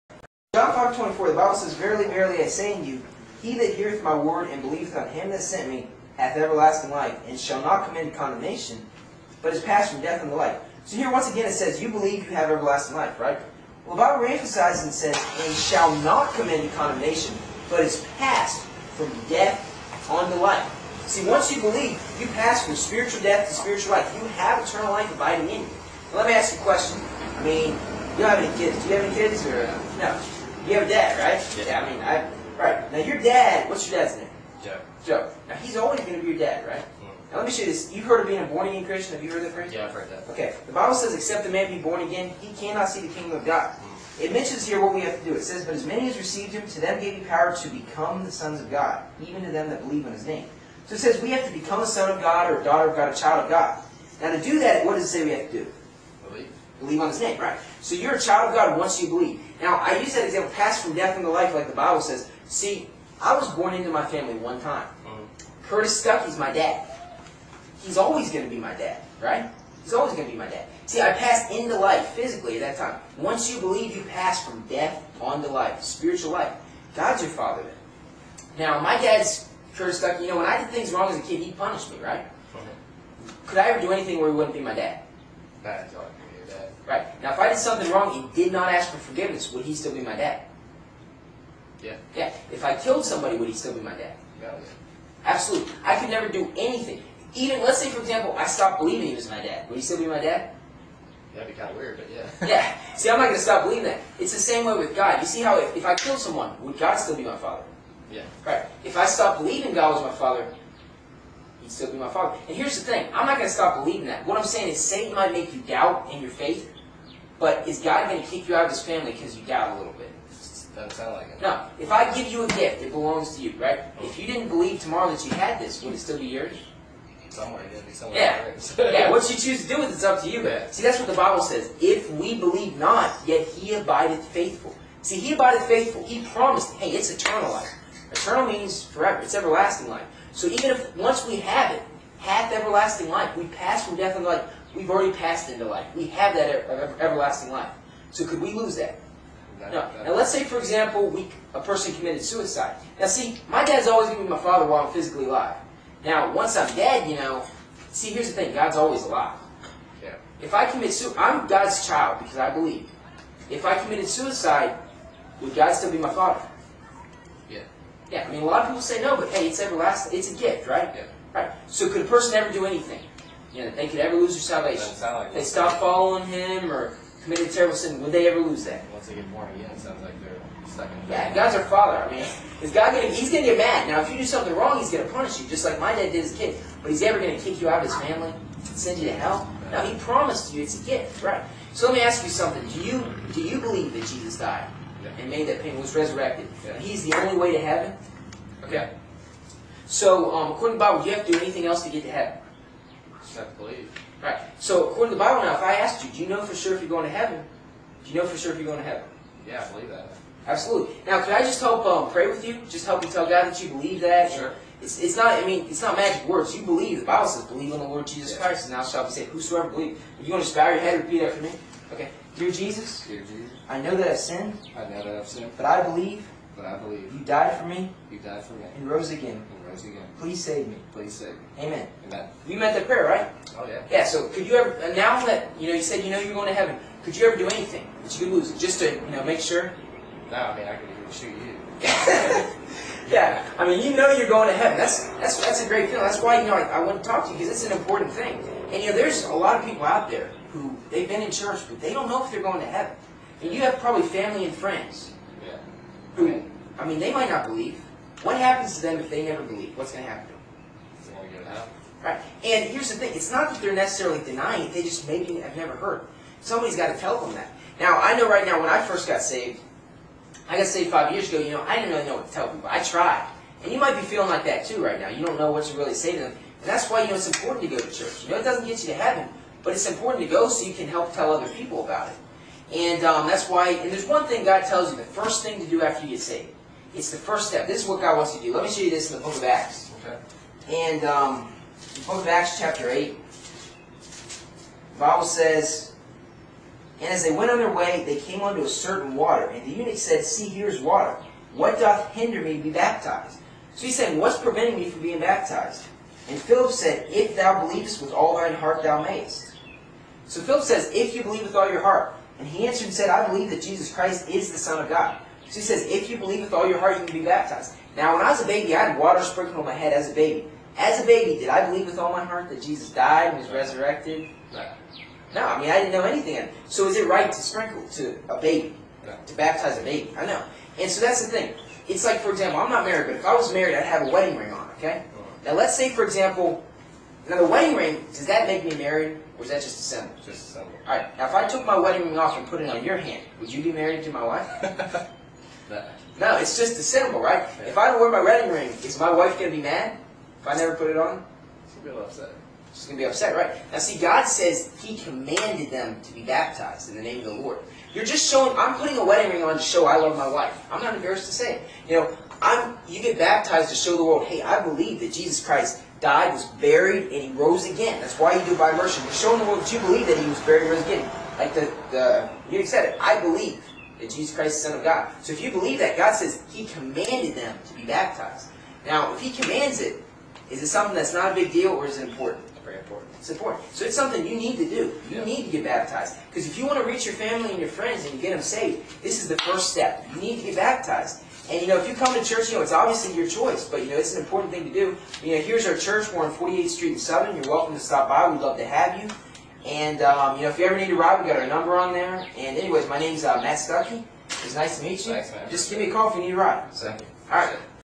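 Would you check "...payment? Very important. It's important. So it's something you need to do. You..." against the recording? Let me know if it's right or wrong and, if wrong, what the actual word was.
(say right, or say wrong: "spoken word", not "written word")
wrong: "important", not "payment".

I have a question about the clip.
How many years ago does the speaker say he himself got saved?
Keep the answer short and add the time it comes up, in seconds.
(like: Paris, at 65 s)
5, at 270 s.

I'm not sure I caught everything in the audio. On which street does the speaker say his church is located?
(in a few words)
48th Street.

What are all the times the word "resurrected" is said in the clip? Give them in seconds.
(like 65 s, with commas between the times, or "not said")
195 s, 323 s.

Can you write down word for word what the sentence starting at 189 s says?
No, he promised you it's a gift, right?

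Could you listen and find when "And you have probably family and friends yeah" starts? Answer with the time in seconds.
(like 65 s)
253 s.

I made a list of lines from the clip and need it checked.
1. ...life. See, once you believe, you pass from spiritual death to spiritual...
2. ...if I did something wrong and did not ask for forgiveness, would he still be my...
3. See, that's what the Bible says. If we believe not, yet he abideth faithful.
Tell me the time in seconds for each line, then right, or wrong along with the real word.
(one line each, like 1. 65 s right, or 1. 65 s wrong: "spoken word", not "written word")
1. 20 s right
2. 87 s right
3. 130 s right.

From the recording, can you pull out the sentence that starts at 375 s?
So if you believe that, God says he commanded them to be baptized.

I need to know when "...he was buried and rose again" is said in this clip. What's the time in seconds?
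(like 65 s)
370 s.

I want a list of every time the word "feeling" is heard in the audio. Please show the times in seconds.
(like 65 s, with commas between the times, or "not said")
245 s, 274 s.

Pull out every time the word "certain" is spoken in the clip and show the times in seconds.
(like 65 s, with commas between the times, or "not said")
298 s.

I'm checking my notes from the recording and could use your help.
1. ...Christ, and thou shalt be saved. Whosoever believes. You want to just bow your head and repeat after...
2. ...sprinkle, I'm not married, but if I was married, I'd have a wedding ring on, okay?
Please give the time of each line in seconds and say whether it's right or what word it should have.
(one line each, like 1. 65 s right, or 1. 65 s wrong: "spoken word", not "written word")
1. 218 s right
2. 332 s wrong: "example", not "sprinkle".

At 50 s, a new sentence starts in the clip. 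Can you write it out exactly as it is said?
So it says we have to become a son of God or a daughter of God, a child of God.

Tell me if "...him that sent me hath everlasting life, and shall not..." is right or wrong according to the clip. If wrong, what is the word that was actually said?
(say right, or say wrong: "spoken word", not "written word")
right.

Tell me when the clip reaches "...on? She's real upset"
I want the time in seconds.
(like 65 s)
350 s.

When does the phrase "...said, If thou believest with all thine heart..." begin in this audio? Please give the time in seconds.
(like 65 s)
306 s.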